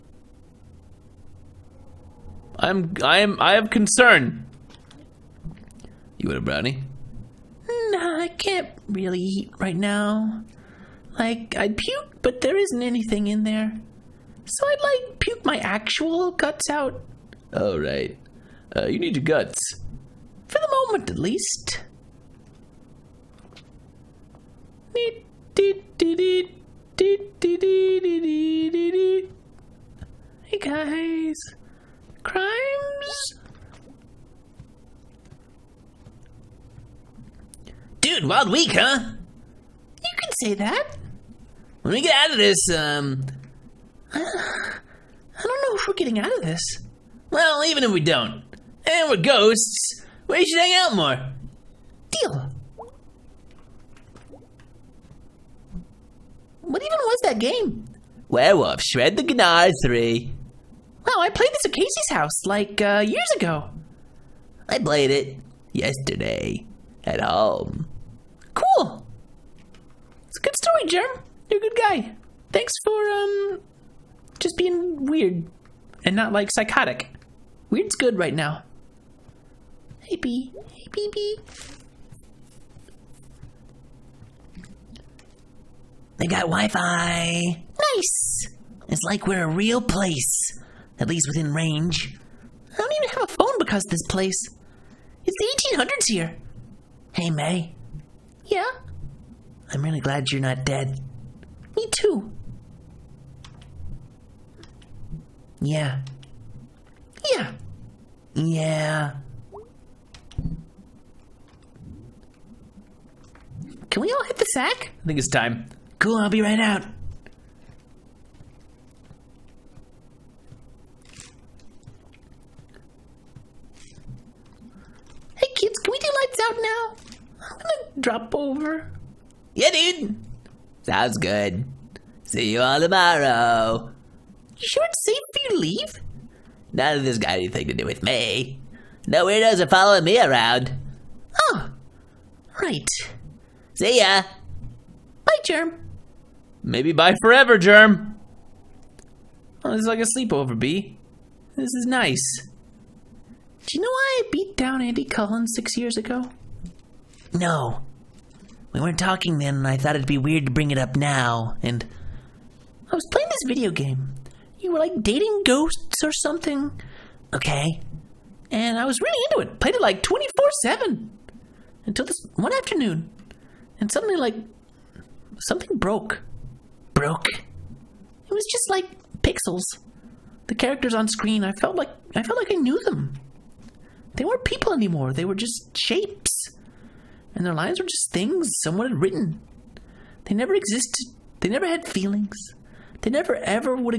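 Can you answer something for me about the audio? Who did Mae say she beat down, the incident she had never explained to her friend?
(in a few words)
Andy Cullen.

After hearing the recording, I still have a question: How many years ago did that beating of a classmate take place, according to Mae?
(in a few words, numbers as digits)
6.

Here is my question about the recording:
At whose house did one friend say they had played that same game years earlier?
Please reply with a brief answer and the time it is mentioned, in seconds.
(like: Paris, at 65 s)
Casey's, at 61 s.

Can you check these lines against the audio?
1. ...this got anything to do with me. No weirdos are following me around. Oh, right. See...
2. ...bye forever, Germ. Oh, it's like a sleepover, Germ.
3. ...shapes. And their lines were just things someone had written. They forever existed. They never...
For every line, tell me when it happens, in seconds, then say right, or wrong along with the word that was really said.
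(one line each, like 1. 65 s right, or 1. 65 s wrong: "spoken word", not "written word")
1. 137 s right
2. 146 s wrong: "Bea", not "Germ"
3. 185 s wrong: "never", not "forever".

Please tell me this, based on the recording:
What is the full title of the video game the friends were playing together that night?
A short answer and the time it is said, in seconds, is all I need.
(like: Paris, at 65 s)
Werewolf Shred the Gnar 3, at 58 s.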